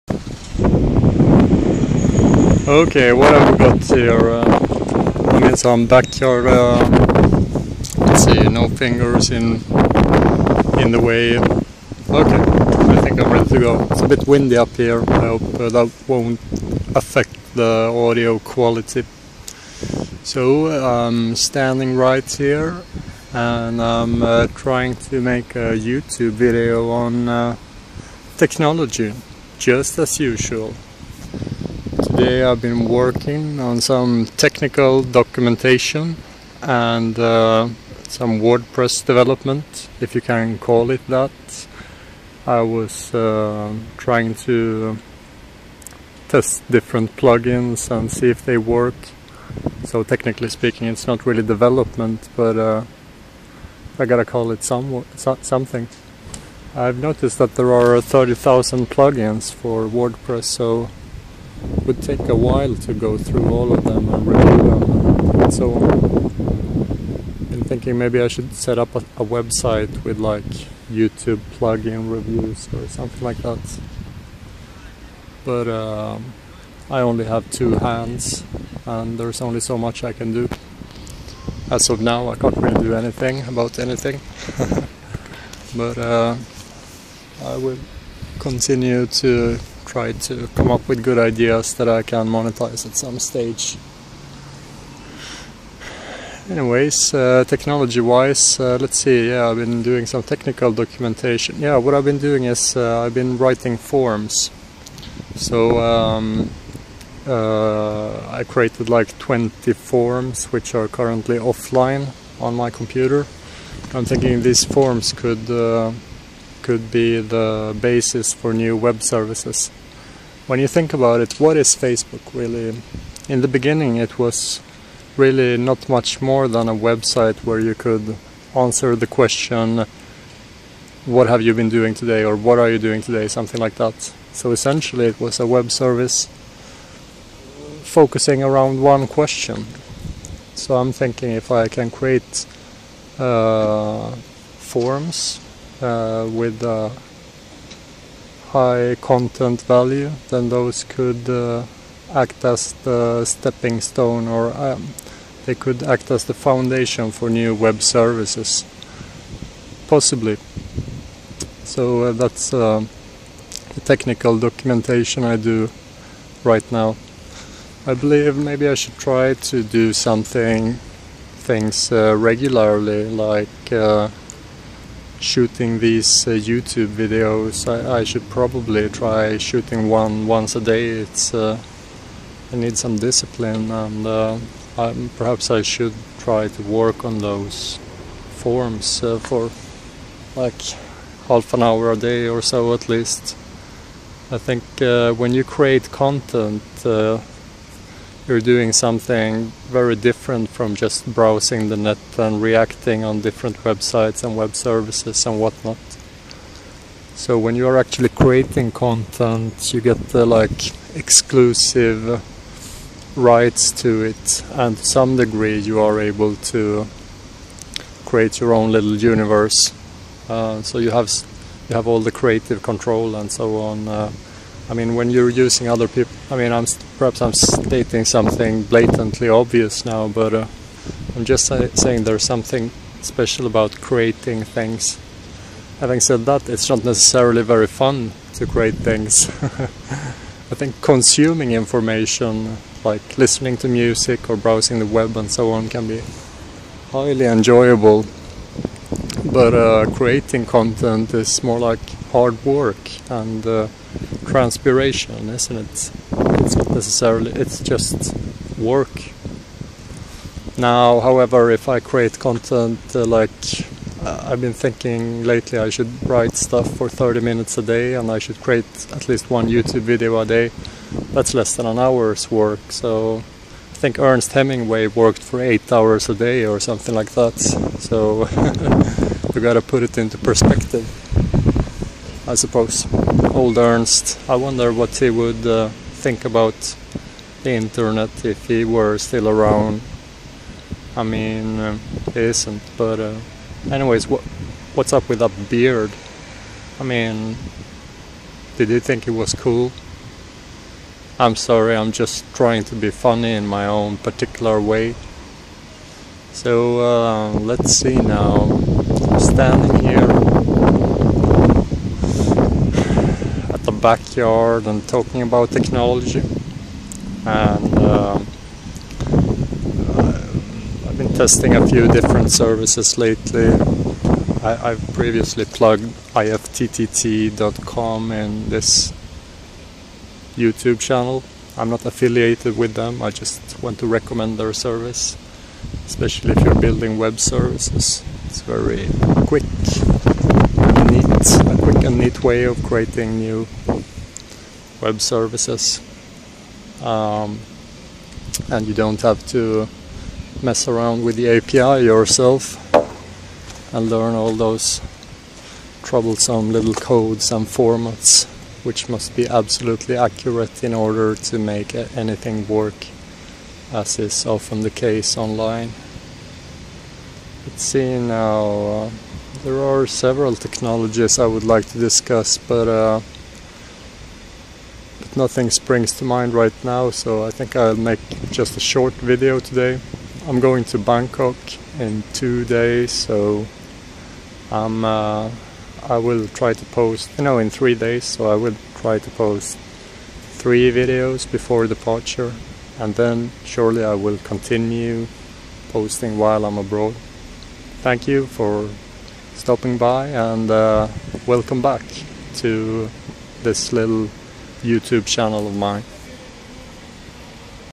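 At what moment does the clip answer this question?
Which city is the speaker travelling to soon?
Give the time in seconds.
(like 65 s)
380 s.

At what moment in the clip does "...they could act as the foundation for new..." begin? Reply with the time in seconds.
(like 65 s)
155 s.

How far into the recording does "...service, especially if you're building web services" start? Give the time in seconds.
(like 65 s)
334 s.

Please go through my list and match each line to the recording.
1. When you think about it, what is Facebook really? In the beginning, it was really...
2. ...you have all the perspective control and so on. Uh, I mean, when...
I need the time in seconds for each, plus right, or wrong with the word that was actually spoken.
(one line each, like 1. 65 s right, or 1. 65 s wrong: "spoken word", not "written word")
1. 120 s right
2. 221 s wrong: "creative", not "perspective".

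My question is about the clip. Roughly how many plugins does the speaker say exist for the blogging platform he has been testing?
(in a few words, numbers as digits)
30,000.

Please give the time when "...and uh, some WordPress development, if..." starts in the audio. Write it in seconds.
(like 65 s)
36 s.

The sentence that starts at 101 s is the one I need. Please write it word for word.
Yeah, what I've been doing is uh, I've been writing forms.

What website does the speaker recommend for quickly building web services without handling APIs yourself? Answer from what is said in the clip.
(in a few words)
ifttt.com.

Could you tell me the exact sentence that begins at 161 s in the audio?
So uh, that's uh, the technical documentation I do right now.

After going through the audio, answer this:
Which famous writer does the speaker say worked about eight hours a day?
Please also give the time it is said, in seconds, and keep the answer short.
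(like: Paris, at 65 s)
Ernest Hemingway, at 273 s.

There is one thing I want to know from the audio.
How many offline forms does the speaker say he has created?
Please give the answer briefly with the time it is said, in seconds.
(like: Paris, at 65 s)
20, at 109 s.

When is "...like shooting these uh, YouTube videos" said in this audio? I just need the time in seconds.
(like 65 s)
173 s.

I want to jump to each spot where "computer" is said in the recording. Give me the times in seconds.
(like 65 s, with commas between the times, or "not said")
112 s.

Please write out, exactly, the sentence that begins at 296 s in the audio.
I mean, did he think it was cool?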